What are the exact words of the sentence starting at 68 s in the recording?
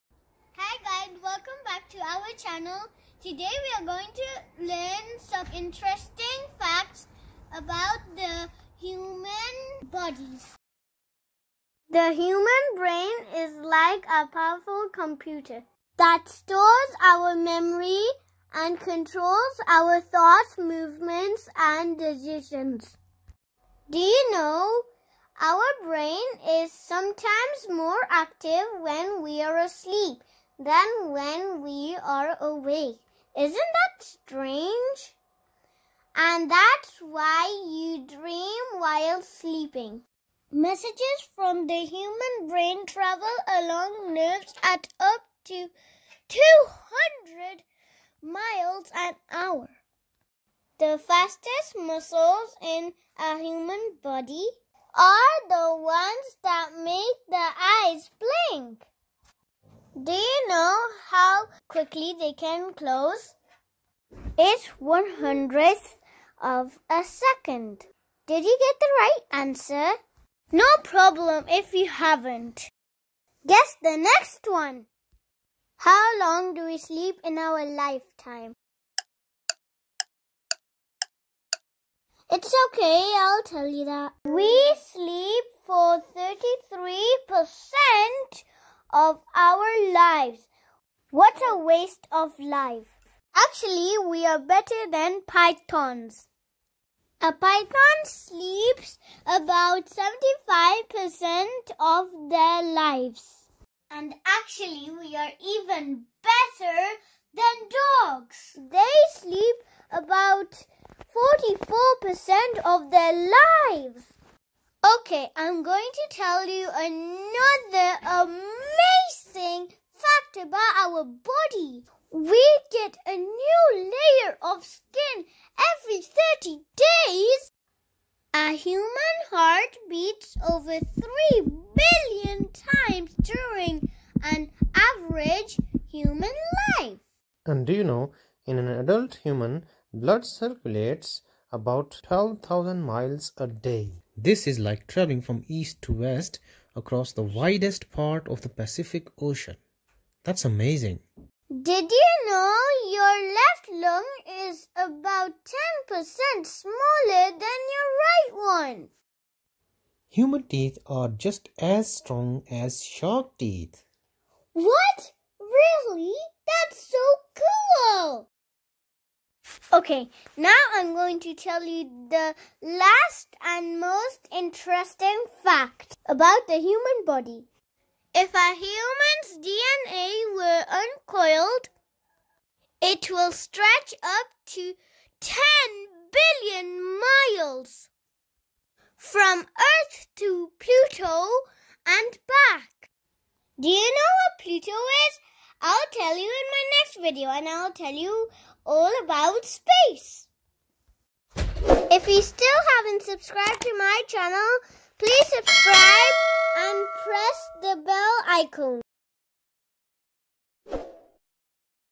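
Did you get the right answer?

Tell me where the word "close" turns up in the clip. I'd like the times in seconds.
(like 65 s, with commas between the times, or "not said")
62 s.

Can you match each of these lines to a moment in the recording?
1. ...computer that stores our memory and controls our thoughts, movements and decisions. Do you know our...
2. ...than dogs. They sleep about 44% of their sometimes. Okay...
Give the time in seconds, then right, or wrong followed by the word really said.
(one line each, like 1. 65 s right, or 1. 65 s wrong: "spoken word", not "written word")
1. 14 s right
2. 107 s wrong: "lives", not "sometimes".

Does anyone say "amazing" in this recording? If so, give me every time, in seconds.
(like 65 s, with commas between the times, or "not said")
118 s, 150 s.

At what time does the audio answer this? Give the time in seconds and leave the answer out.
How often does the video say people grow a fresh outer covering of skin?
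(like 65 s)
125 s.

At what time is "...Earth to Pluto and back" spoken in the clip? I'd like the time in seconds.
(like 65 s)
189 s.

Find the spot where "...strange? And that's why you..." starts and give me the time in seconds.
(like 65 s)
34 s.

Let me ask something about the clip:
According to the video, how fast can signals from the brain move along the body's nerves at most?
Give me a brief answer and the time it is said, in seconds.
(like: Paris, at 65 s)
200 miles an hour, at 46 s.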